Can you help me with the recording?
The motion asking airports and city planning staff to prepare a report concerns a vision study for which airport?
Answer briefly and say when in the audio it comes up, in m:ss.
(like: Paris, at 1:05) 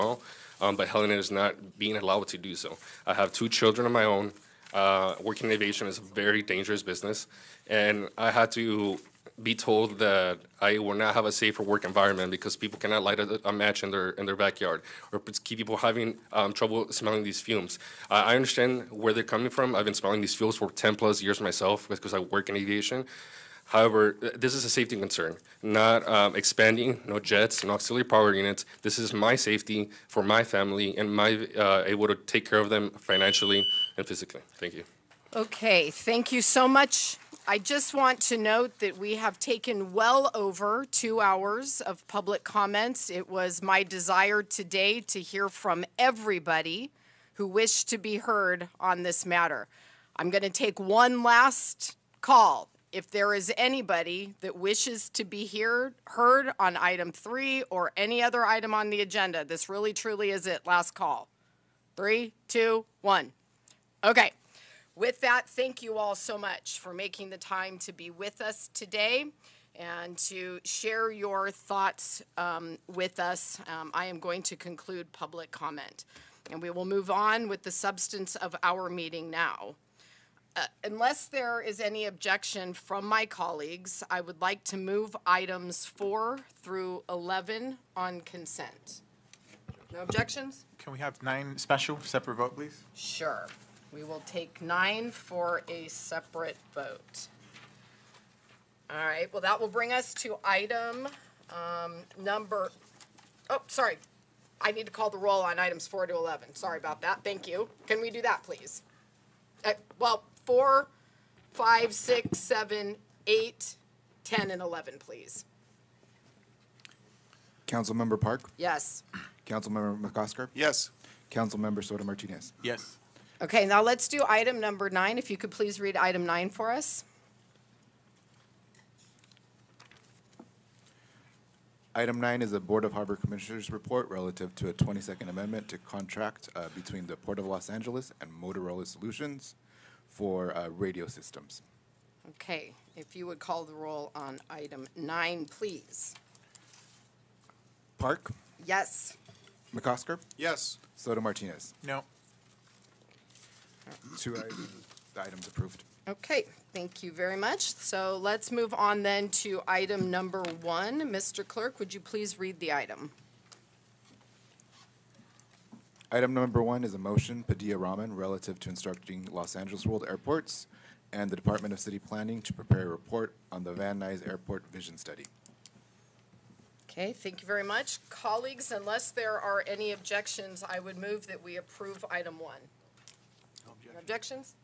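Van Nuys Airport, at 2:53.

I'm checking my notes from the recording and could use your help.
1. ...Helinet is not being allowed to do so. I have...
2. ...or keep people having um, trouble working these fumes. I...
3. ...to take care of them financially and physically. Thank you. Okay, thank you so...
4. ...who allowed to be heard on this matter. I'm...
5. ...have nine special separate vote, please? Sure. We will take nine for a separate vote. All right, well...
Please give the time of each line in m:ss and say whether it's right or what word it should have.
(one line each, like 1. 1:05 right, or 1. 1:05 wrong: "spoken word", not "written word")
1. 0:00 right
2. 0:15 wrong: "smelling", not "working"
3. 0:32 right
4. 0:47 wrong: "wished", not "allowed"
5. 1:30 right.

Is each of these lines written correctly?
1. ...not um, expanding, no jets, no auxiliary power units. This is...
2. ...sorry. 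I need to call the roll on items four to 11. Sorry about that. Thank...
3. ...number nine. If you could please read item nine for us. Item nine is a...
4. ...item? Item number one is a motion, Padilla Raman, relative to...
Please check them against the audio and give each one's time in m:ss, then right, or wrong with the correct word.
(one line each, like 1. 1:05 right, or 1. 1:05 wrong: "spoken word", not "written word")
1. 0:25 right
2. 1:43 right
3. 2:04 right
4. 2:42 right.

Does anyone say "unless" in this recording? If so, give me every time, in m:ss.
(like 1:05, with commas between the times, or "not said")
1:20, 2:58.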